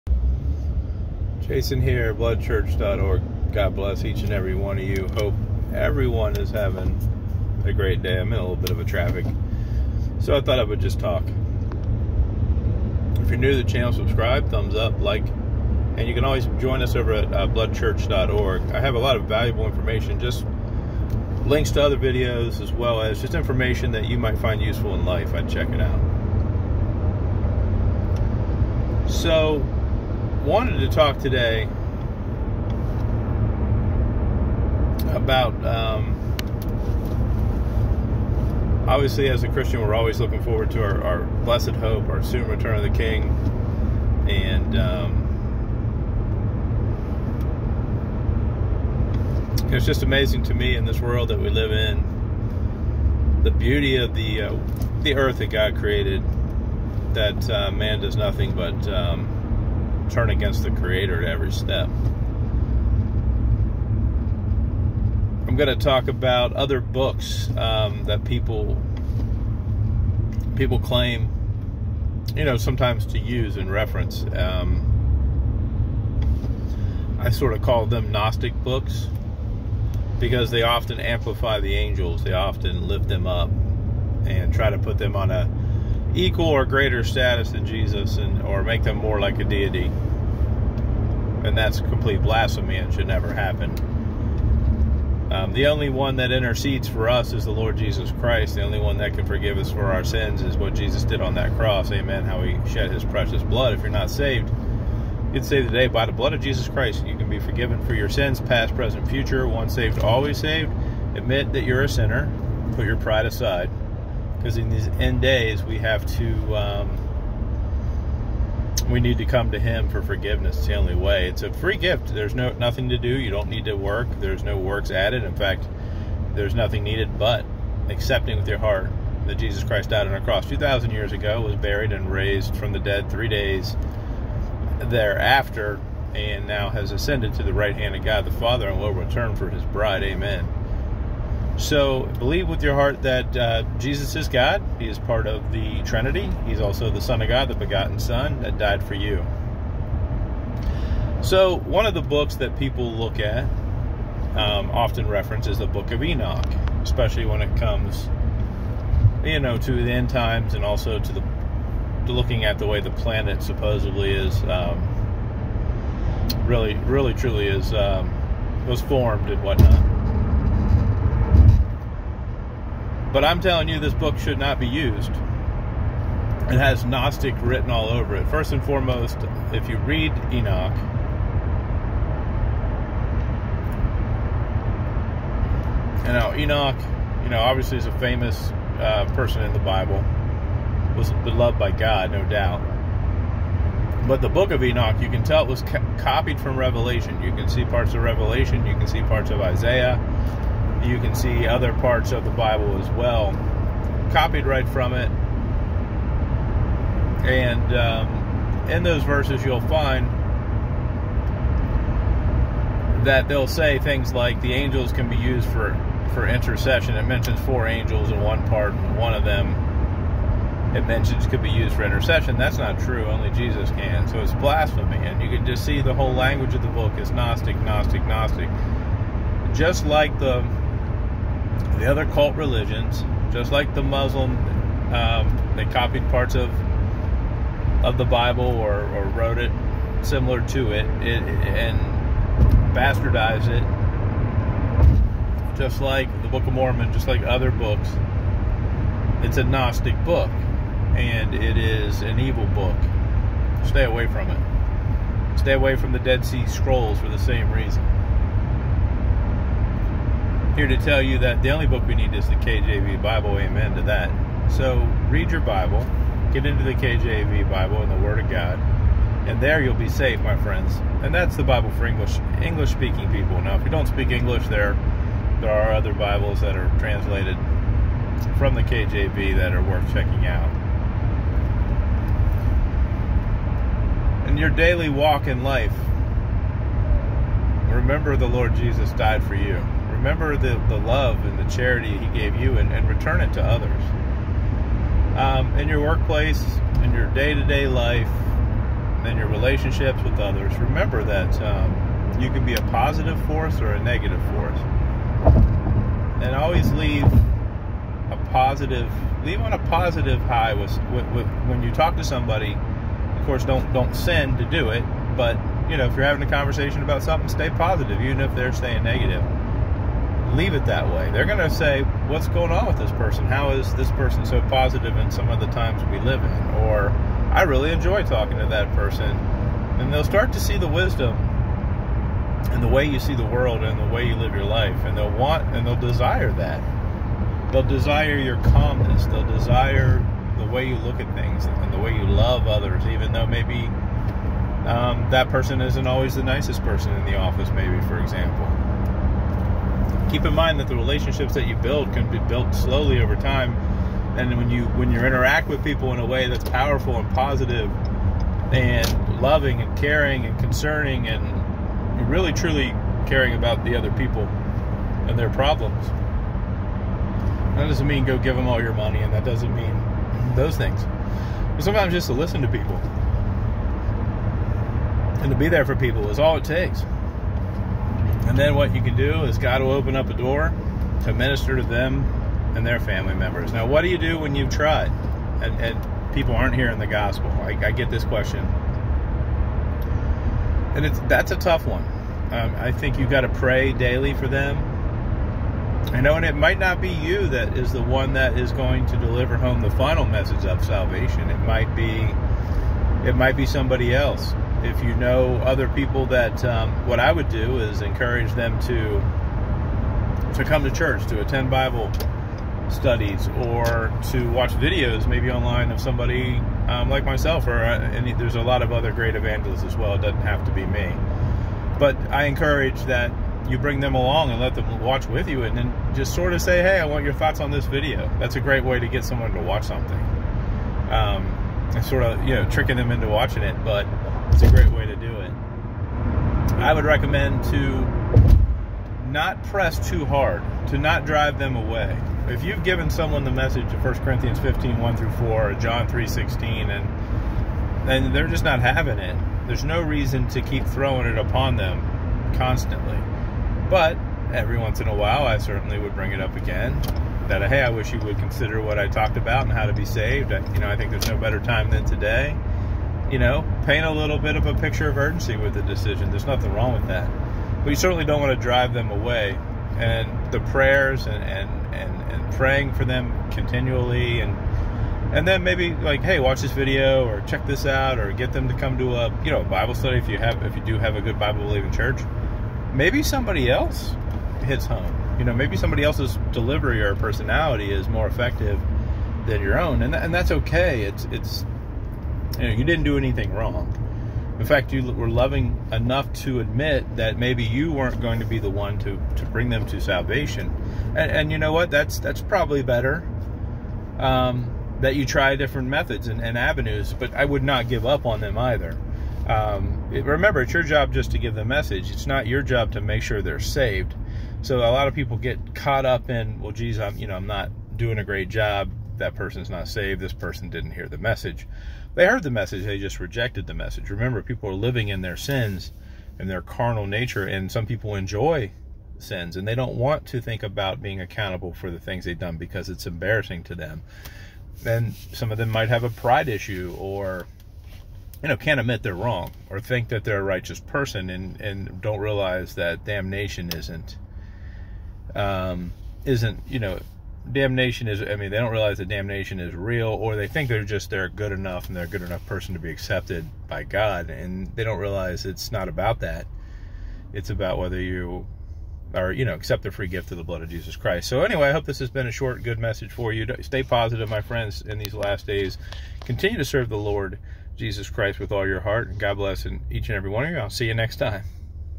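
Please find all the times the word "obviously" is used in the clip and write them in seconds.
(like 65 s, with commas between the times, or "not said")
38 s, 187 s.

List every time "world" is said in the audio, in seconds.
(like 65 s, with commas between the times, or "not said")
50 s, 333 s.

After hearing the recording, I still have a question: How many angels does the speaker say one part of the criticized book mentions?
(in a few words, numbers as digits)
4.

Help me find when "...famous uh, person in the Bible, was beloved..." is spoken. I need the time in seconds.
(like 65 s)
187 s.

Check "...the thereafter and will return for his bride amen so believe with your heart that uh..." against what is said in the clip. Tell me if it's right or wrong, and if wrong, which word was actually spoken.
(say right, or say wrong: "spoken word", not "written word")
wrong: "father", not "thereafter".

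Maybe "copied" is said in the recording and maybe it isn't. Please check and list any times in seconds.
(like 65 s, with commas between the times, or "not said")
195 s, 204 s, 235 s.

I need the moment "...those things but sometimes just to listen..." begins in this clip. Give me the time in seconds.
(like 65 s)
370 s.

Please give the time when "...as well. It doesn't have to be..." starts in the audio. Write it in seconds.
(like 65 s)
419 s.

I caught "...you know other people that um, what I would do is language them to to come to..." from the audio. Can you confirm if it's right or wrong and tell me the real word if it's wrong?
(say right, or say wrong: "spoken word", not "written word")
wrong: "encourage", not "language".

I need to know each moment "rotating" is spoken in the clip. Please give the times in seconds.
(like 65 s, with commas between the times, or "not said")
not said.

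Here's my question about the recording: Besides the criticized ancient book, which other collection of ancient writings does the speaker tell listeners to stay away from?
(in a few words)
Dead Sea Scrolls.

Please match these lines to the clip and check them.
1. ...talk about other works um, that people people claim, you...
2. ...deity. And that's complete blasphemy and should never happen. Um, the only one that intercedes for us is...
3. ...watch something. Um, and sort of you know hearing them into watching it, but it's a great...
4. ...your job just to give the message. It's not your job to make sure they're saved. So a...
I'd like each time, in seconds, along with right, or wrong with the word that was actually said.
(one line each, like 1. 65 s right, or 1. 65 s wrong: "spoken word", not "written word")
1. 65 s wrong: "books", not "works"
2. 89 s right
3. 429 s wrong: "tricking", not "hearing"
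4. 510 s right.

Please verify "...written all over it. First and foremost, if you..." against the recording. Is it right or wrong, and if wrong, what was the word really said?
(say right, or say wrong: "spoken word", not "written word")
right.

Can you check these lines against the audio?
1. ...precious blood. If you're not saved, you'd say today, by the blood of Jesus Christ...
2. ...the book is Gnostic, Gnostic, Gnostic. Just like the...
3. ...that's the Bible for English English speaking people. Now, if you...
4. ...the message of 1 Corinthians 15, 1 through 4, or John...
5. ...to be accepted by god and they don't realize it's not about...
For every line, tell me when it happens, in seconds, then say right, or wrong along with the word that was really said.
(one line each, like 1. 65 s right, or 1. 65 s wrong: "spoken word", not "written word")
1. 103 s right
2. 226 s right
3. 271 s right
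4. 443 s right
5. 552 s right.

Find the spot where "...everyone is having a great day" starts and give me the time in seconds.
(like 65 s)
5 s.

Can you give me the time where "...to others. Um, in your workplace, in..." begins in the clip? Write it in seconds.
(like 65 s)
293 s.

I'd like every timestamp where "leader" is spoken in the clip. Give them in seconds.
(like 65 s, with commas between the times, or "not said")
not said.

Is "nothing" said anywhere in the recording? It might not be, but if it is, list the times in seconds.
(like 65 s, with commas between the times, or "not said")
58 s, 122 s, 126 s, 466 s.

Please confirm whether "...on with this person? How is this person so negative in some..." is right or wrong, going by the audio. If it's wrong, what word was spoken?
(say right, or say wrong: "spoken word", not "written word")
wrong: "positive", not "negative".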